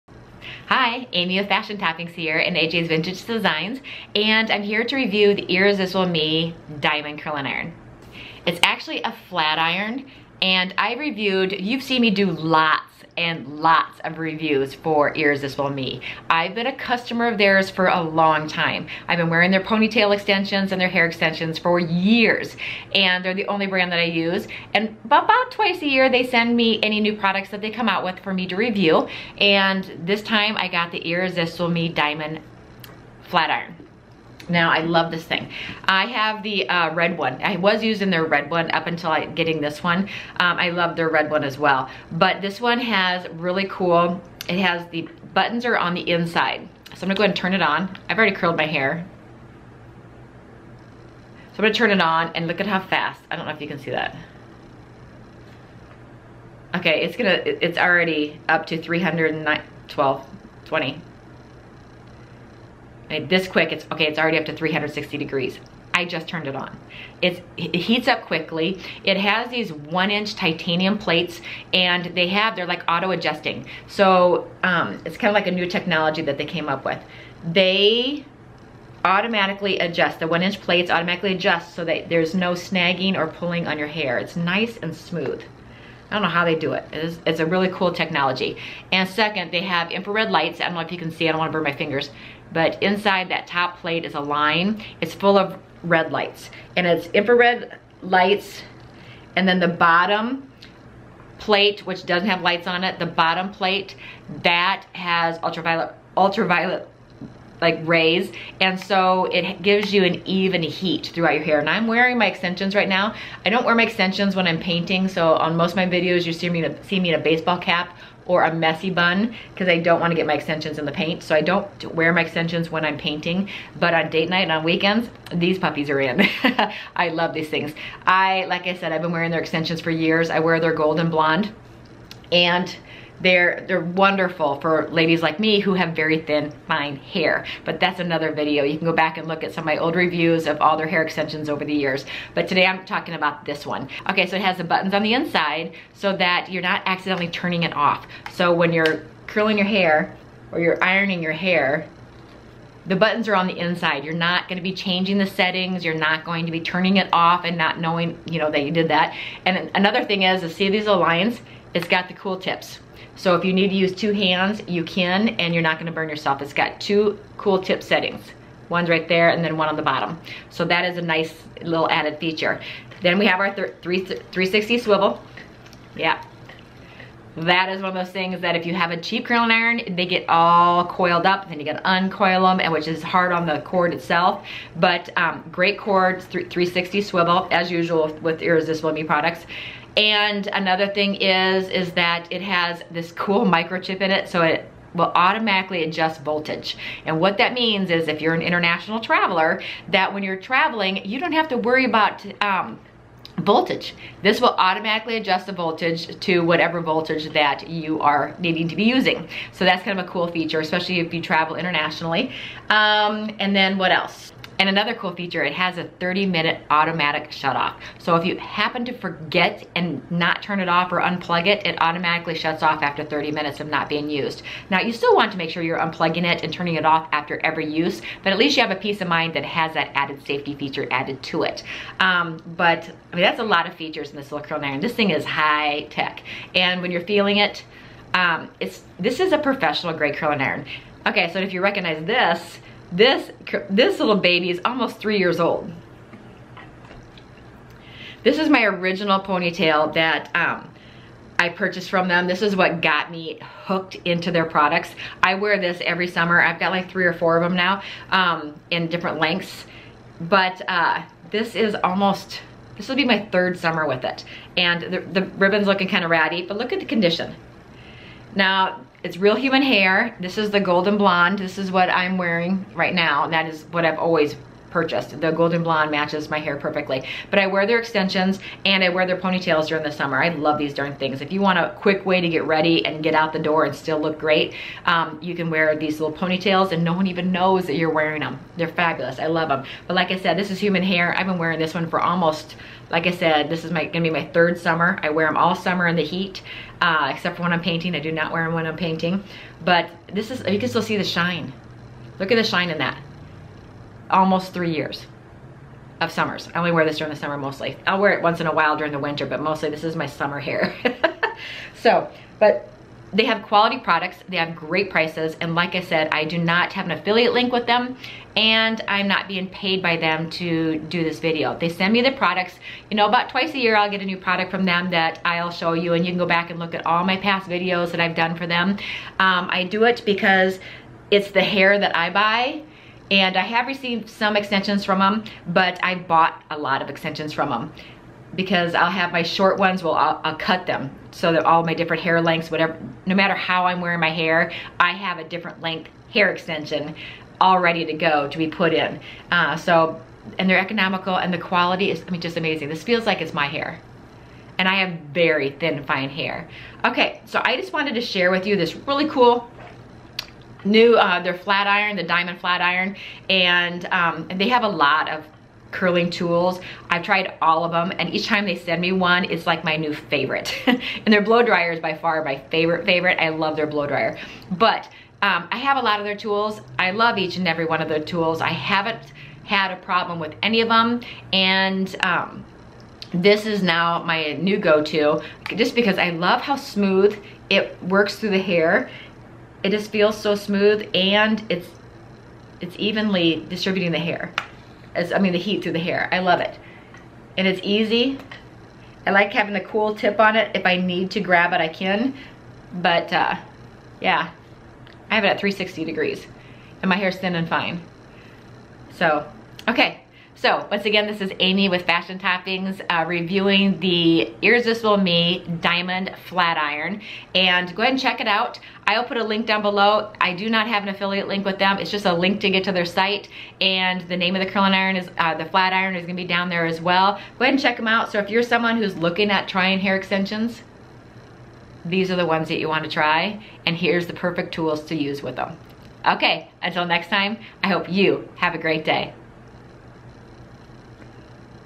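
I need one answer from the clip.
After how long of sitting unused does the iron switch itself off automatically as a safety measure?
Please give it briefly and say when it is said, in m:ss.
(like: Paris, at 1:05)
30 minutes, at 3:35.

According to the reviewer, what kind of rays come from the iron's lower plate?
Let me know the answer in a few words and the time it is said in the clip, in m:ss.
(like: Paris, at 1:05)
ultraviolet, at 1:45.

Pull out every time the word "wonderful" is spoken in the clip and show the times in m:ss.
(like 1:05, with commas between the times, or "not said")
2:13.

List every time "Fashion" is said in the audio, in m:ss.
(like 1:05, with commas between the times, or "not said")
0:01, 6:51.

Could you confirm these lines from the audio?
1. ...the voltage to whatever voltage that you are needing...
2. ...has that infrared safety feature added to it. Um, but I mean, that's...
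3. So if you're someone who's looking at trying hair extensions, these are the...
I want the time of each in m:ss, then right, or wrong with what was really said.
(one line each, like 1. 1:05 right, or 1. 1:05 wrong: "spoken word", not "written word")
1. 3:25 right
2. 3:49 wrong: "added", not "infrared"
3. 7:08 right.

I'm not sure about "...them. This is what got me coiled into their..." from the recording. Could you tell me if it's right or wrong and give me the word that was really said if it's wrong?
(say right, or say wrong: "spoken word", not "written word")
wrong: "hooked", not "coiled".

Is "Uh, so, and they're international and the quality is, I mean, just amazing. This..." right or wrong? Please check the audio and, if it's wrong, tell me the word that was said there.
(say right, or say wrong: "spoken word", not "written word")
wrong: "economical", not "international".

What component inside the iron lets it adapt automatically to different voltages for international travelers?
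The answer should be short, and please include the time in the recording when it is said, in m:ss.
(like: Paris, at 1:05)
microchip, at 3:13.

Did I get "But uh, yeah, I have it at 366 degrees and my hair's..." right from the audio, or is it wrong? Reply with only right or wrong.
wrong.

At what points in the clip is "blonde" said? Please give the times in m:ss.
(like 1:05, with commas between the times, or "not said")
2:11, 4:30, 4:35.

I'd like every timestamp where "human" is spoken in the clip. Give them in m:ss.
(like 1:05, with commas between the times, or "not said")
4:29, 4:50.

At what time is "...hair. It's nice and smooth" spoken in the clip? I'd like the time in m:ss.
1:23.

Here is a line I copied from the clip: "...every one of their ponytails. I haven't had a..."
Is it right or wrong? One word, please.
wrong.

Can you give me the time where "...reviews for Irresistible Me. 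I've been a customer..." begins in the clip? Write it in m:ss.
0:14.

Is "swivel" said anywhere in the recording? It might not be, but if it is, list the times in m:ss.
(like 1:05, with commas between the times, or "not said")
2:54, 3:07.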